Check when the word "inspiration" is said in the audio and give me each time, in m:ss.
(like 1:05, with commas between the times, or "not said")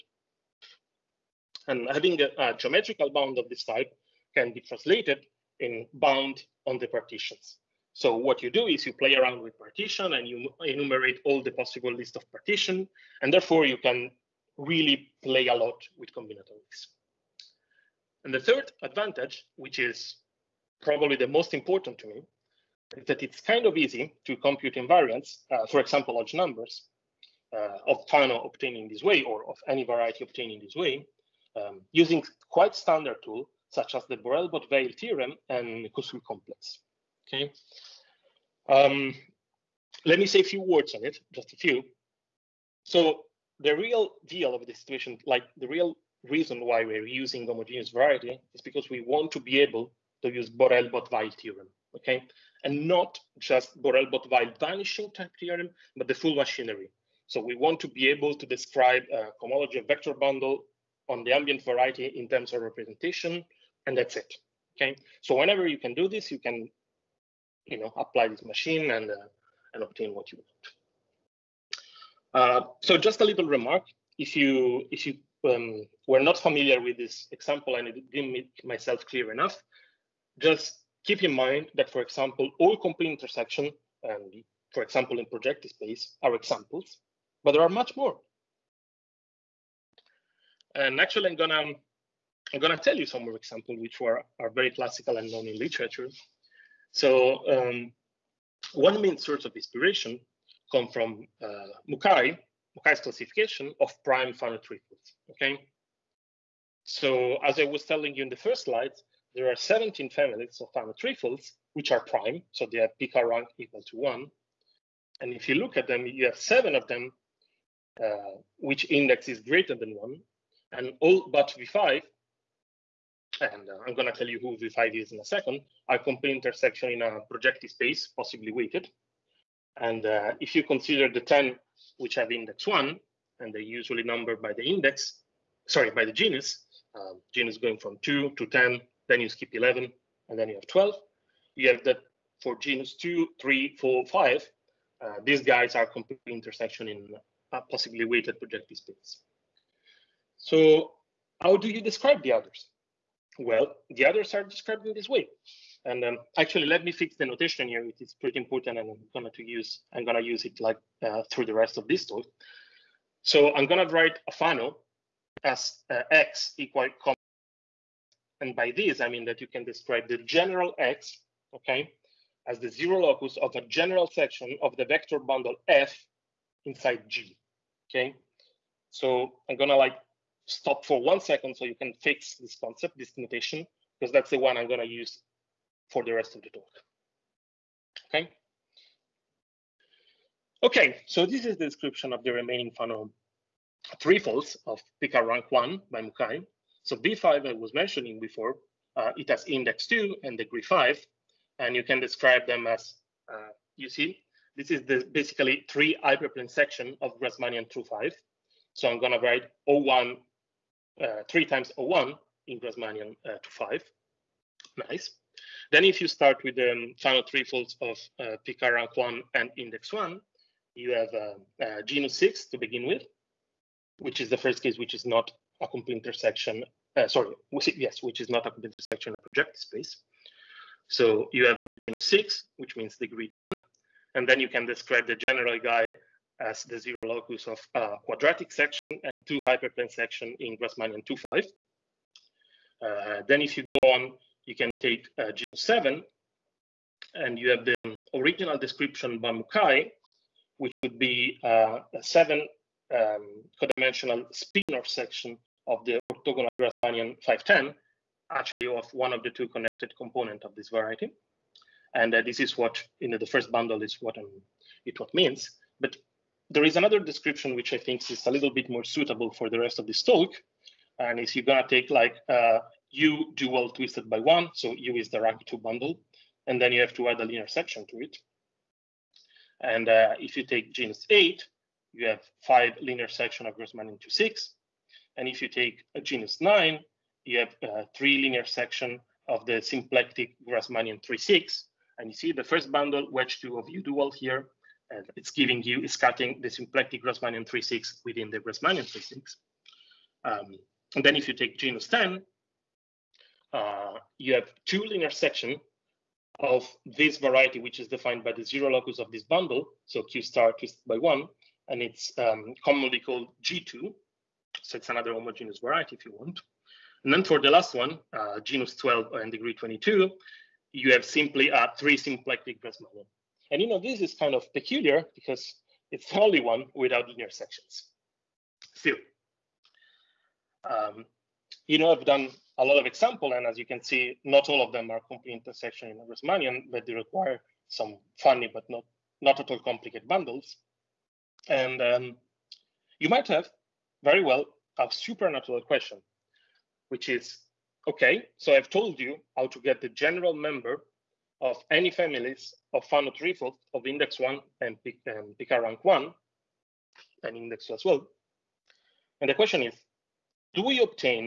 1:39.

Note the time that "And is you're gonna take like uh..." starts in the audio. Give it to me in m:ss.
4:30.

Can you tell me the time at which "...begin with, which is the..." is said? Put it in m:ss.
3:42.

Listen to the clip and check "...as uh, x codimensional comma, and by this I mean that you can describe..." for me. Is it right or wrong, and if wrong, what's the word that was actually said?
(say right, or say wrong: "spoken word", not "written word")
wrong: "equal", not "codimensional".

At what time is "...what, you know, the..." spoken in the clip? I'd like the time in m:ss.
4:22.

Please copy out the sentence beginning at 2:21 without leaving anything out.
You have that for genus two, three, four, five.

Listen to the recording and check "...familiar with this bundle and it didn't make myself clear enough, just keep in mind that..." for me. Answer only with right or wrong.
wrong.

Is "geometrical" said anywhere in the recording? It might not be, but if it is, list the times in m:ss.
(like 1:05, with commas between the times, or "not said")
0:02.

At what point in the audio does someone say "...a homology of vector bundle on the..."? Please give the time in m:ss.
0:59.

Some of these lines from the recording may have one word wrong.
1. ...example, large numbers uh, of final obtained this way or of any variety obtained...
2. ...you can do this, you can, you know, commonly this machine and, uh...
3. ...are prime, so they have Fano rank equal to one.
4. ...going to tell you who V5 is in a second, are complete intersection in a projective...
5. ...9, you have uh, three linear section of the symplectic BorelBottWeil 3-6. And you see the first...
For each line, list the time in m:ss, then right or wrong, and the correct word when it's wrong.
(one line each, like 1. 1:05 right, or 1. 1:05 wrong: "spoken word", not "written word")
1. 0:25 right
2. 1:05 wrong: "apply", not "commonly"
3. 1:51 wrong: "Picard", not "Fano"
4. 2:03 right
5. 4:46 wrong: "Grassmannian", not "BorelBottWeil".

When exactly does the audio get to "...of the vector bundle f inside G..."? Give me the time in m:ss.
2:54.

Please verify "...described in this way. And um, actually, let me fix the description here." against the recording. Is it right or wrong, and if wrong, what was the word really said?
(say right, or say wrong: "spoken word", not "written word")
wrong: "notation", not "description".